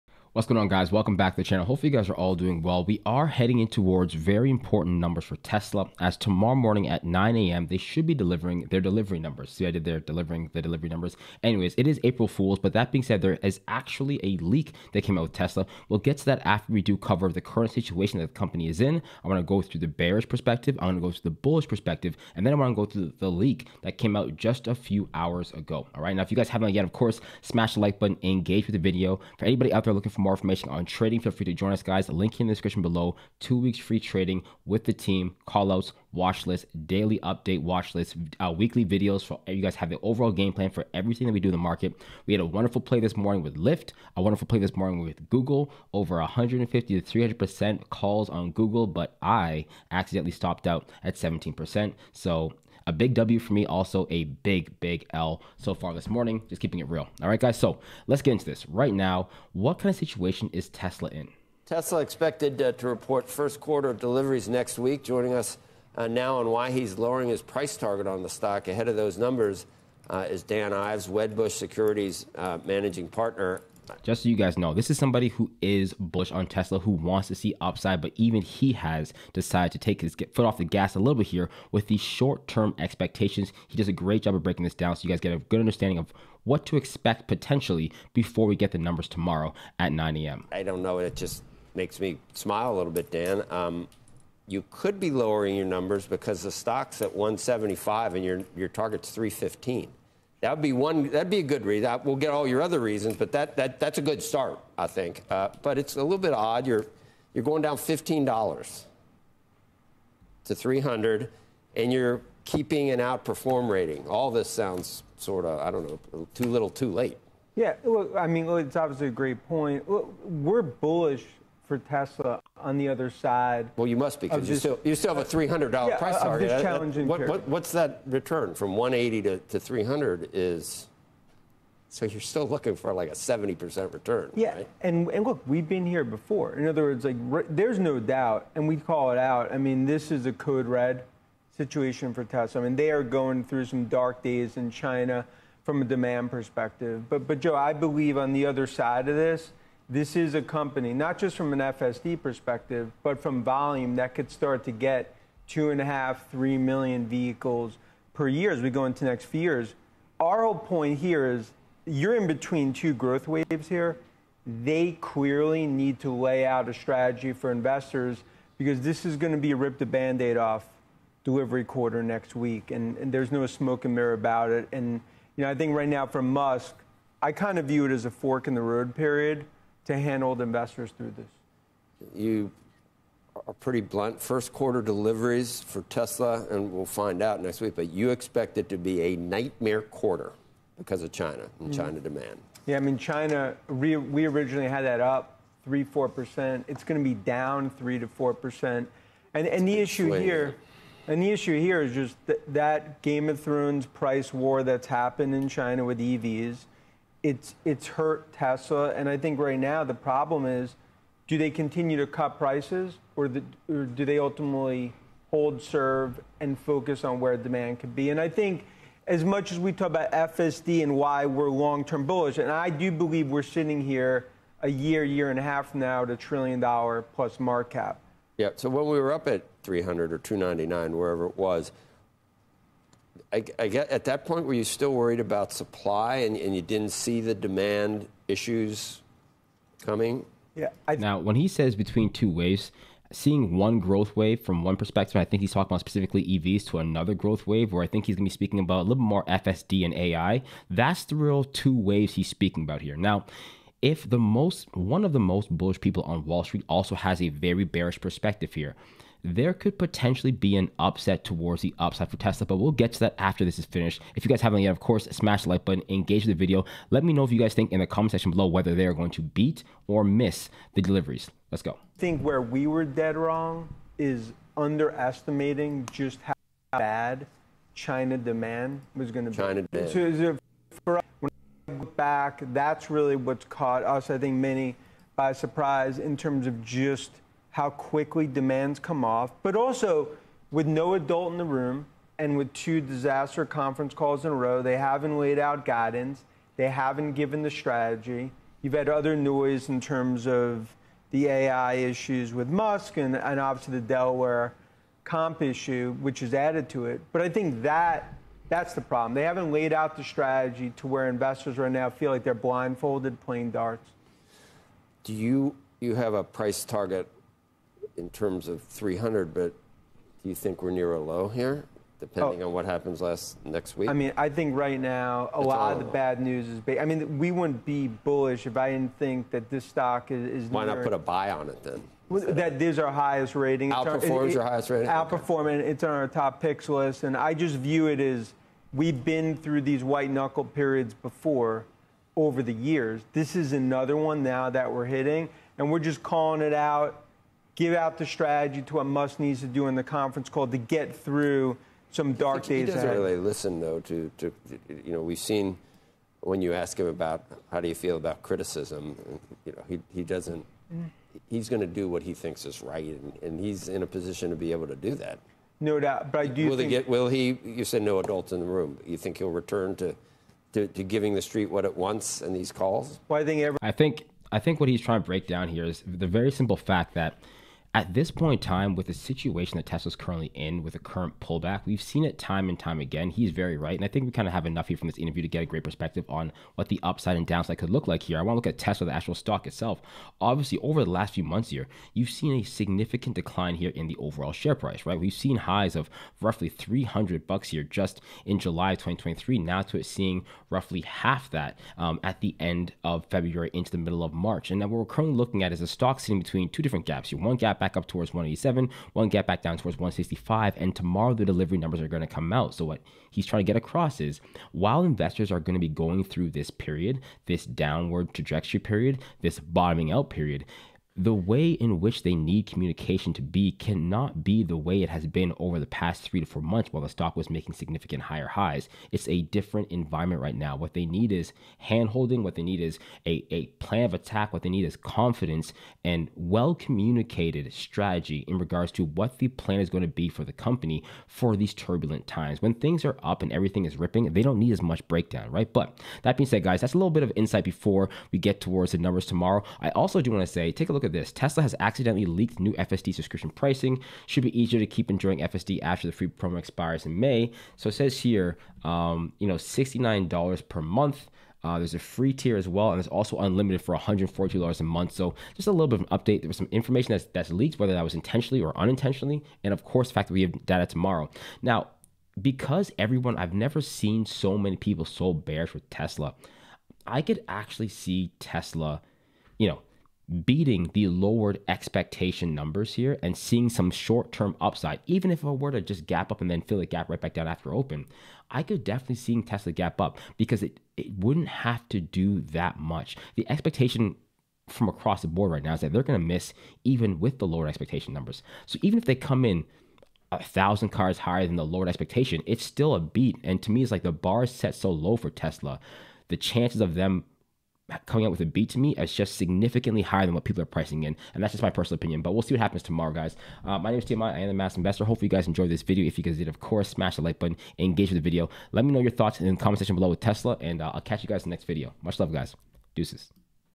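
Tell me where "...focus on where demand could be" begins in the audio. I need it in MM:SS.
03:36.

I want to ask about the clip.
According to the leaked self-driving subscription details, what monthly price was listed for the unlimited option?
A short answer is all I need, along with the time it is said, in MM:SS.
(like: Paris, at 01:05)
$142, at 07:43.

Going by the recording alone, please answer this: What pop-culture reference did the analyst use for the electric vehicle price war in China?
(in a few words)
Game of Thrones.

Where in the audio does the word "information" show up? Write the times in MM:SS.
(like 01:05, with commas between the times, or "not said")
00:30, 07:46.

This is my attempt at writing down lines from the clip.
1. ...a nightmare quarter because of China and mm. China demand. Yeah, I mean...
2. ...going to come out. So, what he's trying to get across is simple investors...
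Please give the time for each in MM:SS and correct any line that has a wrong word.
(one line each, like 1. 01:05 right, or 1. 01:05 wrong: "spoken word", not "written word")
1. 03:09 right
2. 06:51 wrong: "while", not "simple".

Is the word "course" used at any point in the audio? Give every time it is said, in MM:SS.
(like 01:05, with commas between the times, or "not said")
00:26, 04:24, 07:49, 08:36.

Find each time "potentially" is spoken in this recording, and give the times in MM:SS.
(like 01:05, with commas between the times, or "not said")
01:27, 04:19.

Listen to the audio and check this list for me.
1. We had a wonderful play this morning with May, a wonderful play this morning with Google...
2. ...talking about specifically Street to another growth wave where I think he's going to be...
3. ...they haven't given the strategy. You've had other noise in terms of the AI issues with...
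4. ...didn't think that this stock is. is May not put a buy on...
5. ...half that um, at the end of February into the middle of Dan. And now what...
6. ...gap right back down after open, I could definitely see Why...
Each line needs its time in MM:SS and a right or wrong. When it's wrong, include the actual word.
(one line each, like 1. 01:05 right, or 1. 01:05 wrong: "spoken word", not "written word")
1. 00:42 wrong: "Lyft", not "May"
2. 04:05 wrong: "EVs", not "Street"
3. 04:56 right
4. 05:28 wrong: "Why", not "May"
5. 06:40 wrong: "March", not "Dan"
6. 08:06 wrong: "Tesla", not "Why".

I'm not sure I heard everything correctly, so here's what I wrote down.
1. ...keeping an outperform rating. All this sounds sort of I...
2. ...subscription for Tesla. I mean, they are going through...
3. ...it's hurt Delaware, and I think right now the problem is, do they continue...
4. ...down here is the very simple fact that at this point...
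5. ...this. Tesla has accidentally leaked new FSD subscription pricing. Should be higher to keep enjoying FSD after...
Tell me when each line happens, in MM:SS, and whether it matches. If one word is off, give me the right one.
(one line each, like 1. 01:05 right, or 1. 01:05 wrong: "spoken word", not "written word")
1. 01:52 right
2. 02:21 wrong: "situation", not "subscription"
3. 03:27 wrong: "Tesla", not "Delaware"
4. 06:15 right
5. 07:30 wrong: "easier", not "higher".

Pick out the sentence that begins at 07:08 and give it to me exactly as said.
It's a different environment right now.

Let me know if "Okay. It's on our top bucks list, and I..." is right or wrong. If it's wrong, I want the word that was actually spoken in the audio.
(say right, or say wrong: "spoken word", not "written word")
wrong: "picks", not "bucks".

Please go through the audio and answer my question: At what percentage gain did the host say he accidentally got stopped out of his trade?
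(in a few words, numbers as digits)
17%.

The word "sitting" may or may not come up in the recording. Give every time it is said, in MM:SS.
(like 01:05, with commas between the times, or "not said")
03:43, 06:46.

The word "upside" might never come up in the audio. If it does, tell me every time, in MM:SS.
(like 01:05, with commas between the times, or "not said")
01:17, 04:21, 06:26, 08:04.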